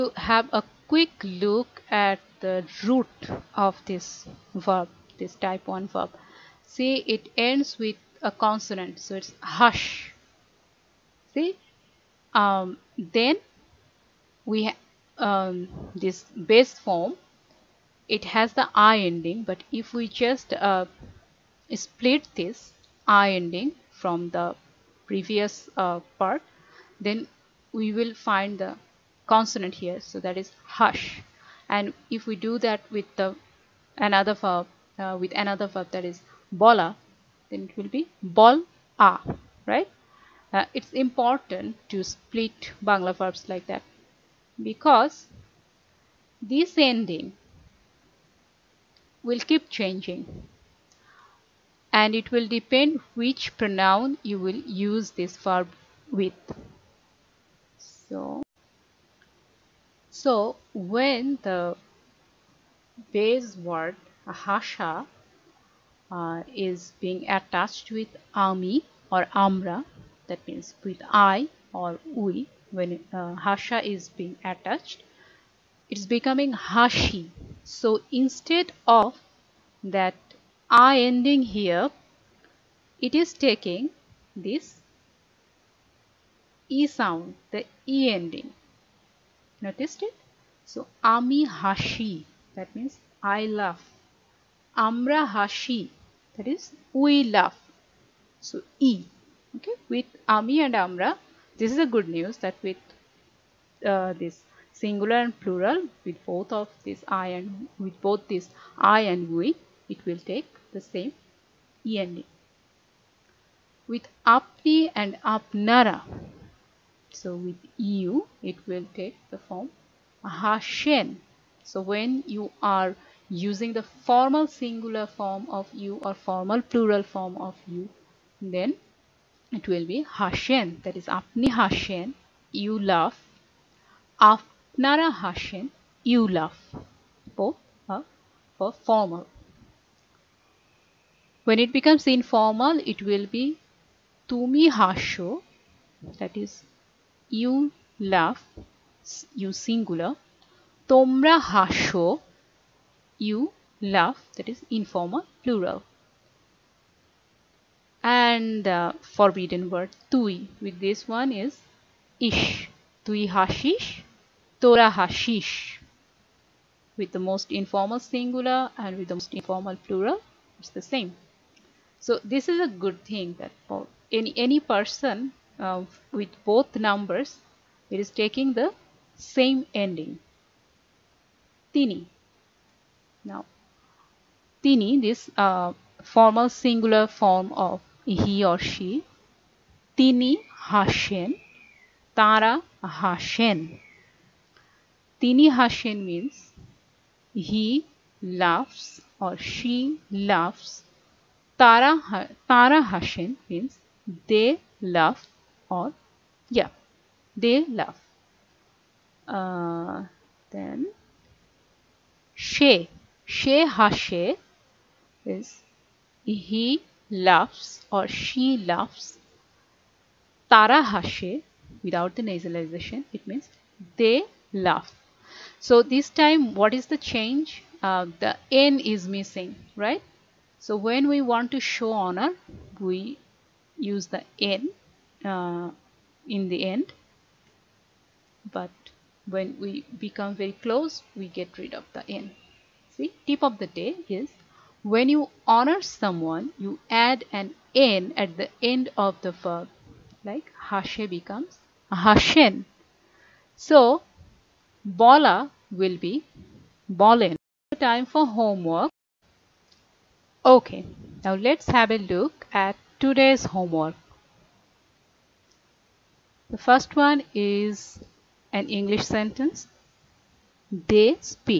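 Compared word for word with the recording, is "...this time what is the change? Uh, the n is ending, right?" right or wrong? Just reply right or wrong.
wrong.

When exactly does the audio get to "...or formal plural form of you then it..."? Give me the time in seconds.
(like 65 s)
126 s.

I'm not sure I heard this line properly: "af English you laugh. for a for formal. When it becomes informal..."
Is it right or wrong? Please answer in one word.
wrong.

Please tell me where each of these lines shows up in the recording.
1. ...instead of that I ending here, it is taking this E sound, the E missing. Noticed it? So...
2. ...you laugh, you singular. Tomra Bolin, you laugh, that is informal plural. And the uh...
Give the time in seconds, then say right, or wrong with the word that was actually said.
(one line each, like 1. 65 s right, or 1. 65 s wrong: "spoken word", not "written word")
1. 78 s wrong: "ending", not "missing"
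2. 147 s wrong: "Hasho", not "Bolin".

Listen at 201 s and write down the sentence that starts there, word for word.
Tara, Tara Hashin means they laugh or yeah, they laugh.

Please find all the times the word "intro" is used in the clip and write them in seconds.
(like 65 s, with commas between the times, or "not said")
not said.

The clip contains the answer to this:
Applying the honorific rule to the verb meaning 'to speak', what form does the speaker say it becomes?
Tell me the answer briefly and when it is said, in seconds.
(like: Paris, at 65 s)
Bolin, at 256 s.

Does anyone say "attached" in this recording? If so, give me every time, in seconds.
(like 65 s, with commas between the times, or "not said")
67 s, 74 s.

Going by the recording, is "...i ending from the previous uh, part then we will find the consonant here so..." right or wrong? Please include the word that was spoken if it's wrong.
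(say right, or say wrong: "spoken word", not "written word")
right.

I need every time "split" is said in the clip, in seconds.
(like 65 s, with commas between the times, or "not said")
21 s, 42 s.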